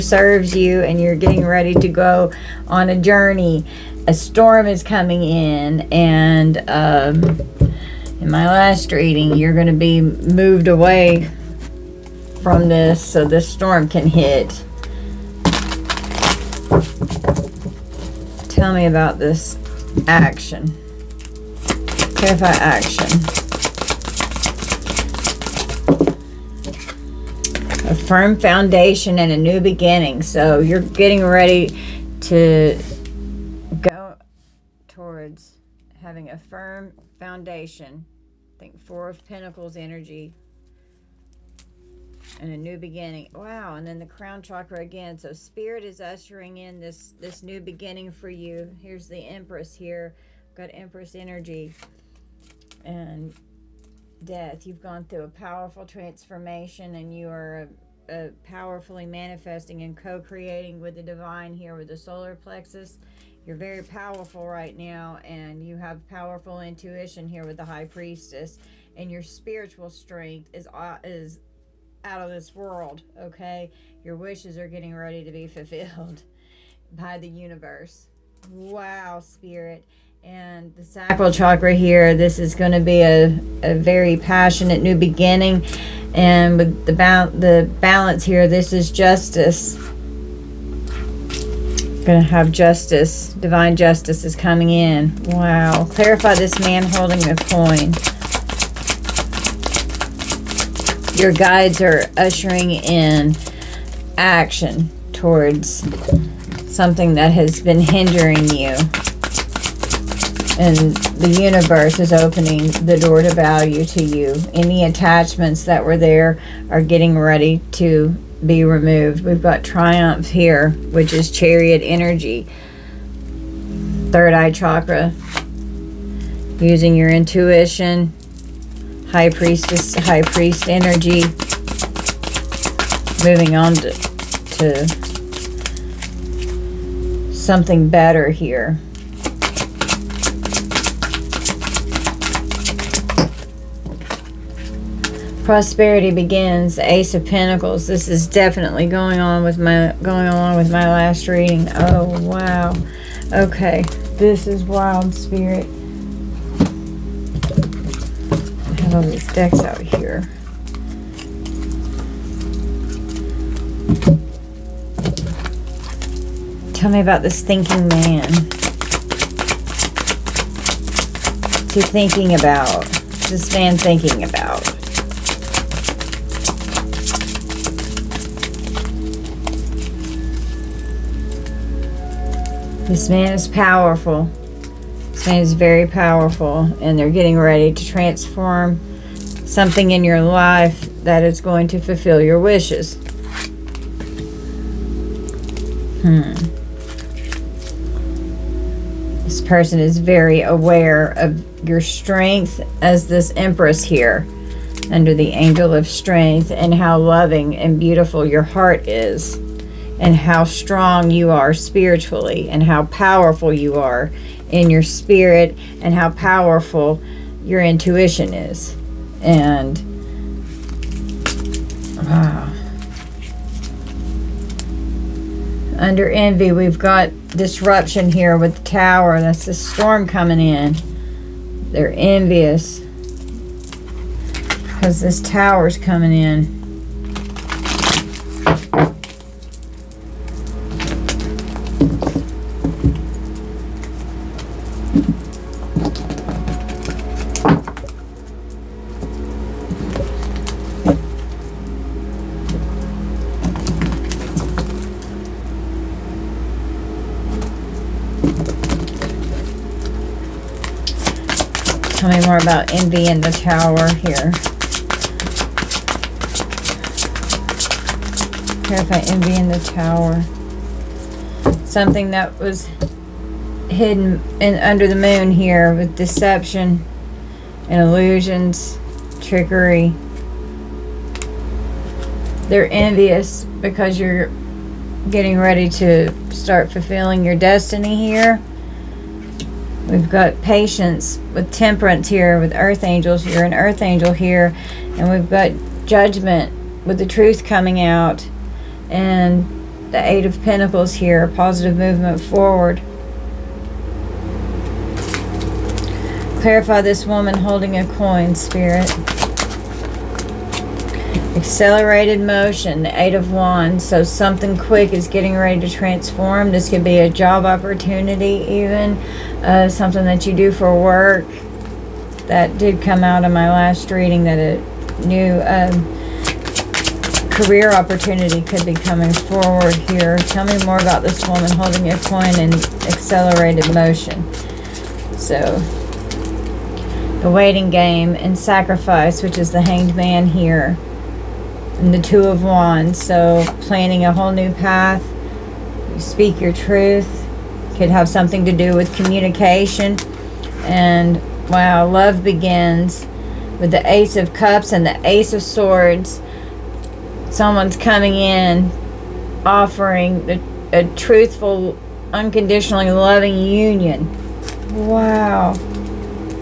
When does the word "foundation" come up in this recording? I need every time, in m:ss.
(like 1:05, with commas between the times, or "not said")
0:28, 0:36.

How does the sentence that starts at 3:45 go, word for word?
under envy we've got disruption here with the tower.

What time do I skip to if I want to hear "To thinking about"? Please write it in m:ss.
2:51.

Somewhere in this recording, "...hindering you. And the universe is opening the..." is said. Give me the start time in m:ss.
1:47.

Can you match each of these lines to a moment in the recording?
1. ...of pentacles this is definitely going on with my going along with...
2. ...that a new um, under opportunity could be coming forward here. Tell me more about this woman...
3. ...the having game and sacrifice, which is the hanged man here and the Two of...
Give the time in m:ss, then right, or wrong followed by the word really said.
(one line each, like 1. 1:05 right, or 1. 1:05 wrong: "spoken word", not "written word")
1. 2:27 right
2. 5:24 wrong: "career", not "under"
3. 5:37 wrong: "waiting", not "having".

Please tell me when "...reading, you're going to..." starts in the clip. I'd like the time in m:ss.
0:08.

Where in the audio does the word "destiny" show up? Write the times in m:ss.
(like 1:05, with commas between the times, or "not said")
4:47.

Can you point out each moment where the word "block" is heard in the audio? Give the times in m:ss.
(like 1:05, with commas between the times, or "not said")
not said.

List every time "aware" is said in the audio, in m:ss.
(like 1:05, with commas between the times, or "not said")
3:20.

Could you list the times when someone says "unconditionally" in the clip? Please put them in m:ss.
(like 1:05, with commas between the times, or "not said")
6:02.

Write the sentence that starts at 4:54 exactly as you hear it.
And we've got judgment with the truth coming out.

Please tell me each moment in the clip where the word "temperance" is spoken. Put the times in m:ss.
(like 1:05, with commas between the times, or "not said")
4:51.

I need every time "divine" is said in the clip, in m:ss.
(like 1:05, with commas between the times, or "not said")
1:01, 1:33.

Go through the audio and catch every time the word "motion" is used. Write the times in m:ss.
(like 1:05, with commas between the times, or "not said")
5:12, 5:33.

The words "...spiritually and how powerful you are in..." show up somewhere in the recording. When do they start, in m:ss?
3:31.